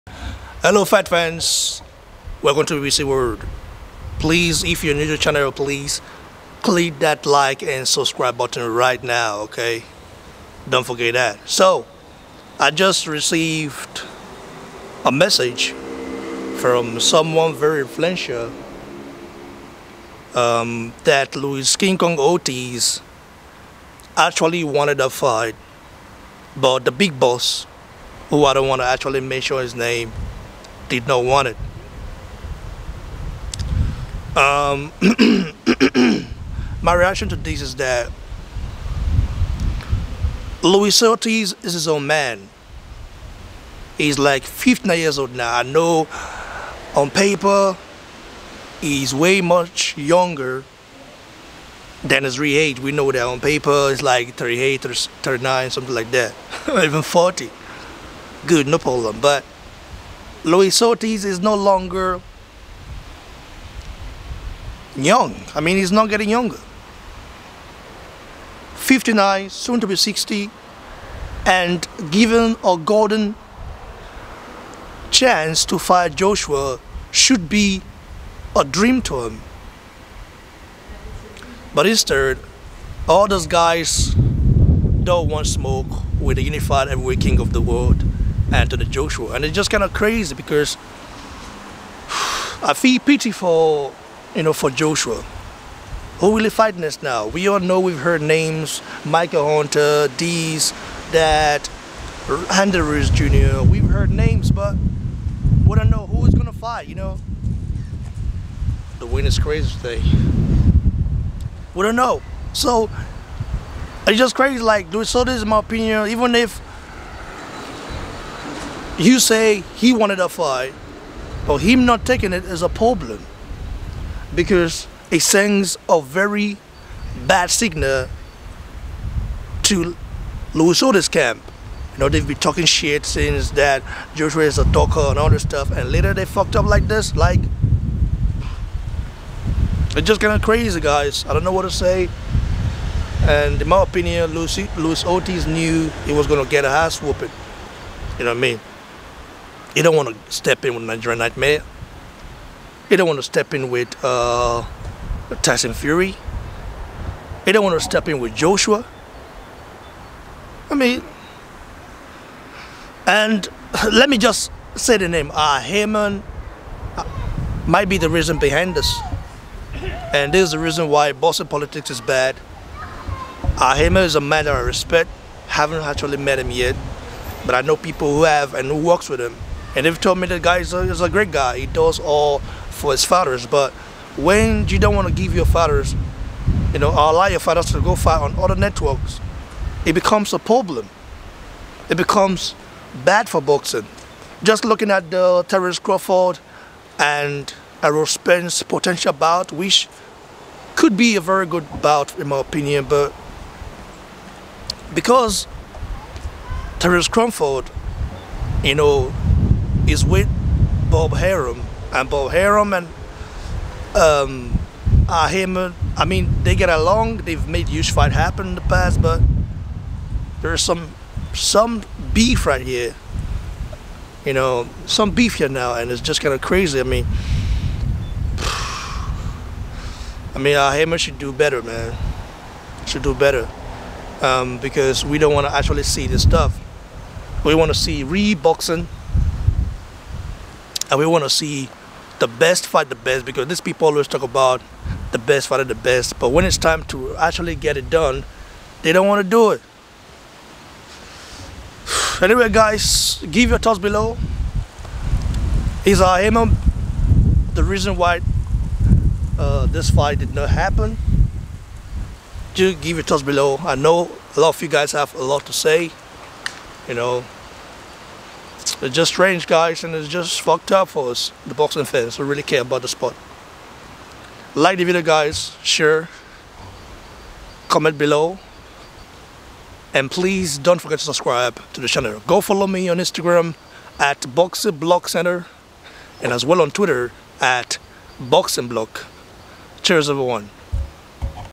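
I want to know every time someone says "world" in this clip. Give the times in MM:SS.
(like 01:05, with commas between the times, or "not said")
00:03, 01:27.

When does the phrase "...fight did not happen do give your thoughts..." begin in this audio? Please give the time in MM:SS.
04:19.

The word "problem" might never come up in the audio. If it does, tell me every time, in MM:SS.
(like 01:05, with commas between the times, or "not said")
00:58, 02:02, 03:10.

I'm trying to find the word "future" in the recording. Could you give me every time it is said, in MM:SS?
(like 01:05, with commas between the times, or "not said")
not said.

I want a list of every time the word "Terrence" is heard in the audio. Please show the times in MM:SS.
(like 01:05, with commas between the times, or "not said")
03:15, 03:26.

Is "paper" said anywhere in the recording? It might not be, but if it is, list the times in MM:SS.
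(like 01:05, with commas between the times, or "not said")
00:47, 00:53.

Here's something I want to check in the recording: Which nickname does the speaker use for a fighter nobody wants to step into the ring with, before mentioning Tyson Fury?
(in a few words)
Nigerian Nightmare.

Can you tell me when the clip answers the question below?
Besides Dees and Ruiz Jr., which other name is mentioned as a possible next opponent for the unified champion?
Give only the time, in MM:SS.
01:39.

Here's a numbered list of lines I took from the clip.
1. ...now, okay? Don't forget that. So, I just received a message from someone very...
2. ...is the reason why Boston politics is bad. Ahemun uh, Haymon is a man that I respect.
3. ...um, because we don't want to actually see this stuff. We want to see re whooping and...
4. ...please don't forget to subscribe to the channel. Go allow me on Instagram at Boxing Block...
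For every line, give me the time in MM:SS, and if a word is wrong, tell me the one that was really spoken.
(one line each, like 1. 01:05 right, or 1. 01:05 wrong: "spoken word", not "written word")
1. 00:09 right
2. 02:50 right
3. 03:54 wrong: "boxing", not "whooping"
4. 04:40 wrong: "follow", not "allow".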